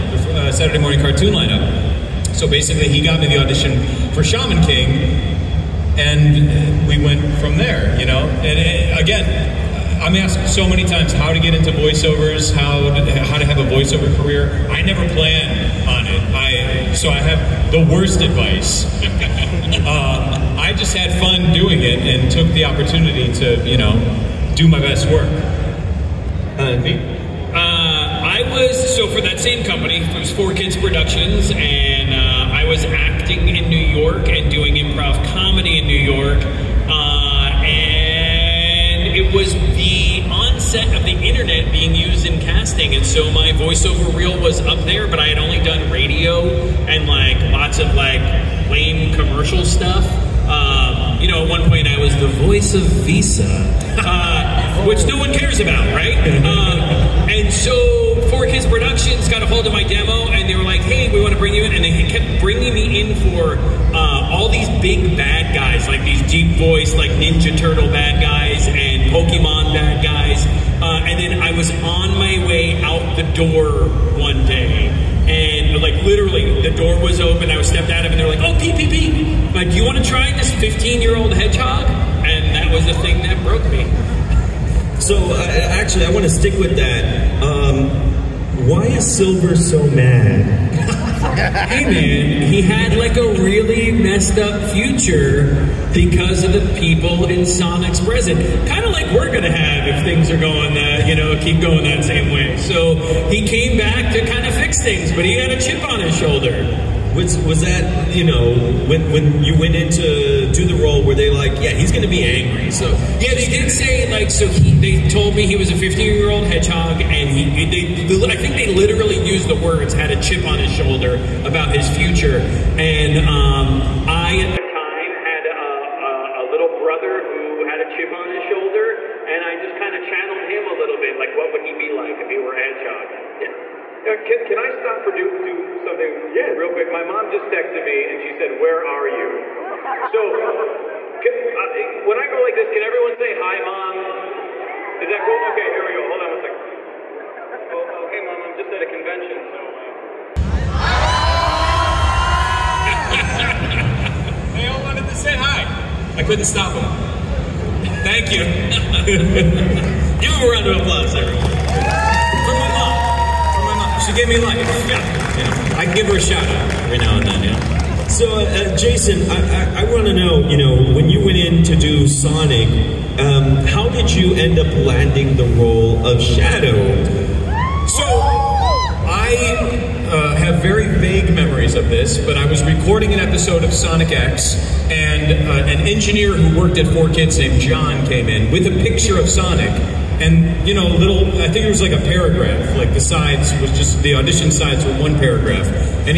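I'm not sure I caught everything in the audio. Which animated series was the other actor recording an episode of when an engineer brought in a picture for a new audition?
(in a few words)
Sonic X.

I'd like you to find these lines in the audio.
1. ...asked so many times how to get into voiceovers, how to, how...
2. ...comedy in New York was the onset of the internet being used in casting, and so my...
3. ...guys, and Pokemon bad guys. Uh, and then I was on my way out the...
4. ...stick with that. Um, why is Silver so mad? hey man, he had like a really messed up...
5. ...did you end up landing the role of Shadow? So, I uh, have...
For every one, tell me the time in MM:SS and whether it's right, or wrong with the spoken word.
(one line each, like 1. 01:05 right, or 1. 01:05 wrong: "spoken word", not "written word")
1. 00:10 right
2. 00:35 right
3. 01:08 right
4. 01:26 right
5. 02:53 right.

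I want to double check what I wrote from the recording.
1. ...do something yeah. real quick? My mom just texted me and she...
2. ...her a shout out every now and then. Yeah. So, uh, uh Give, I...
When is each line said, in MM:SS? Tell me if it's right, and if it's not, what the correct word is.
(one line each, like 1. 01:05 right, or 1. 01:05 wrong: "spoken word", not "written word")
1. 02:15 right
2. 02:46 wrong: "Jason", not "Give".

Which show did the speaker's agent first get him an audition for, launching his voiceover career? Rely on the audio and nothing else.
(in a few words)
Shaman King.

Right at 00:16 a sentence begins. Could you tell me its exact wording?
I so I have the worst advice.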